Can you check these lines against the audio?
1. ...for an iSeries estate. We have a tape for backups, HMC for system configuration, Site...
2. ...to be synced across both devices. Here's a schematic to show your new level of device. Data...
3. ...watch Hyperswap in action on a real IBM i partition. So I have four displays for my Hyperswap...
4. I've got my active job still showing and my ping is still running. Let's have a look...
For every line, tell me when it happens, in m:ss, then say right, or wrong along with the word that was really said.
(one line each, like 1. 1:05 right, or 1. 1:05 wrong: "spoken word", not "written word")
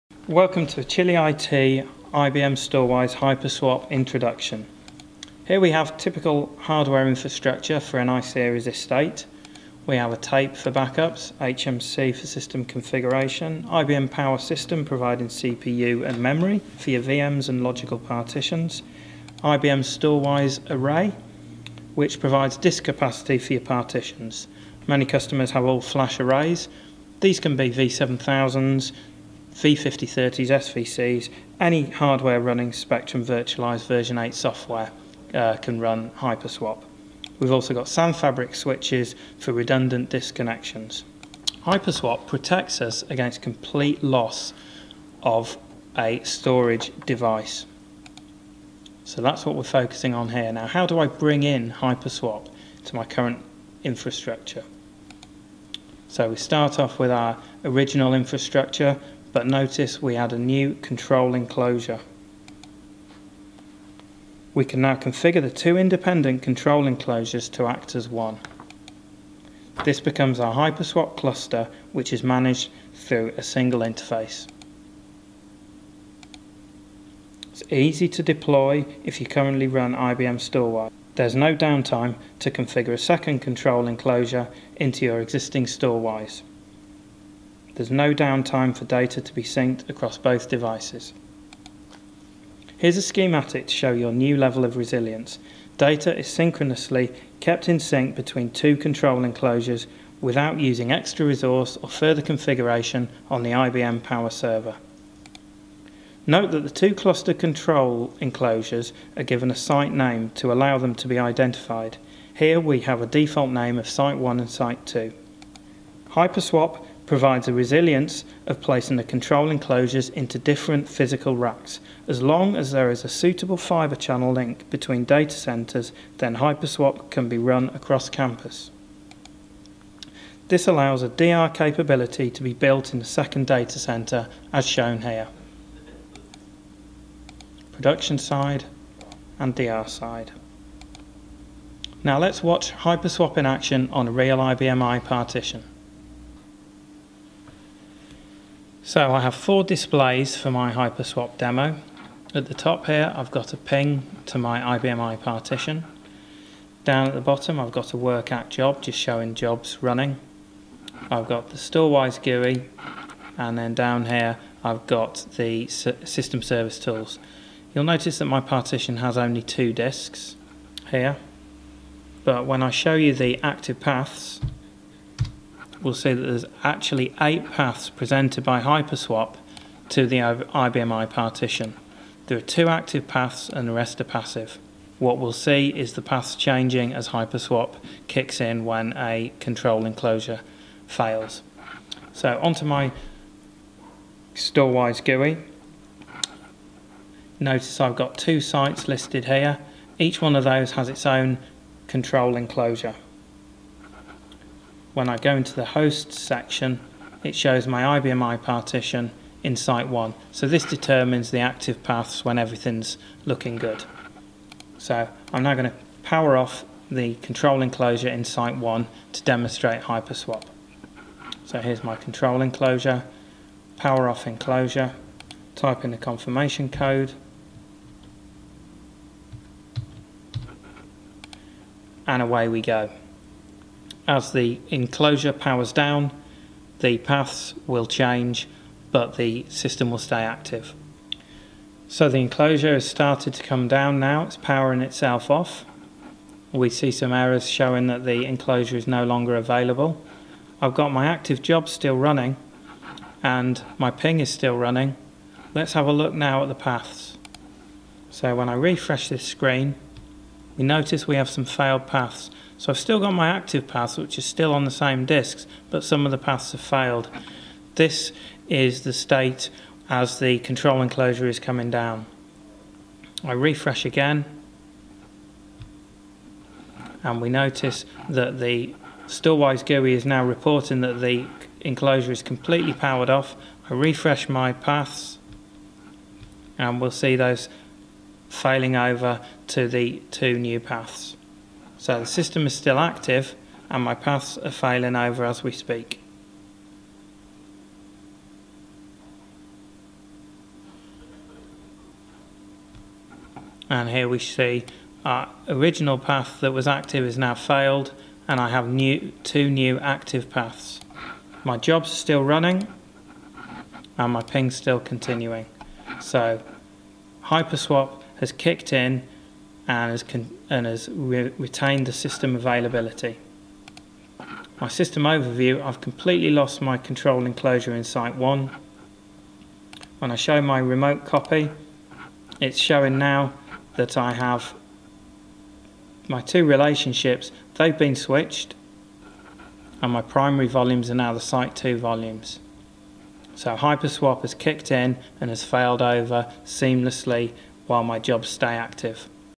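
1. 0:07 wrong: "IBM", not "Site"
2. 1:29 wrong: "resilience", not "device"
3. 2:22 right
4. 4:10 wrong: "running", not "showing".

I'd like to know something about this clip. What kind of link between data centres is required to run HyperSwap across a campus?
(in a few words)
Fibre channel link.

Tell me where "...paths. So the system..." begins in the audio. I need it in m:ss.
4:50.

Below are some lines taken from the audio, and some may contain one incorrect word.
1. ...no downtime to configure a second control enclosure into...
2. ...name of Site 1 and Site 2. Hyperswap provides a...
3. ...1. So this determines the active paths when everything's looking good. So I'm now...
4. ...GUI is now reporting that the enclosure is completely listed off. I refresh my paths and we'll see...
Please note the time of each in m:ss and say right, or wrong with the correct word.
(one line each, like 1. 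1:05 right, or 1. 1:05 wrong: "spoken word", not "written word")
1. 1:21 right
2. 1:53 right
3. 3:29 right
4. 4:39 wrong: "powered", not "listed".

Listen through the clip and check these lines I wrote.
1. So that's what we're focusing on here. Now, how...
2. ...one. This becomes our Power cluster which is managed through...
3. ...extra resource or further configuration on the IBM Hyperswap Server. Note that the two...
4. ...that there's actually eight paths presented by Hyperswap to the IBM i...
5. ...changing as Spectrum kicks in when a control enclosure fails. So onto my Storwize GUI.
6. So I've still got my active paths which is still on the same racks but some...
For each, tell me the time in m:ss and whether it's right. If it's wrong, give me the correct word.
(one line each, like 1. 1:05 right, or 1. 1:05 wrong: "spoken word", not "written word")
1. 0:49 right
2. 1:08 wrong: "Hyperswap", not "Power"
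3. 1:40 wrong: "Power", not "Hyperswap"
4. 2:56 right
5. 3:06 wrong: "Hyperswap", not "Spectrum"
6. 4:22 wrong: "disks", not "racks".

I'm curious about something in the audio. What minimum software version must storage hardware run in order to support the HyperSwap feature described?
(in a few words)
Spectrum Virtualize version 8.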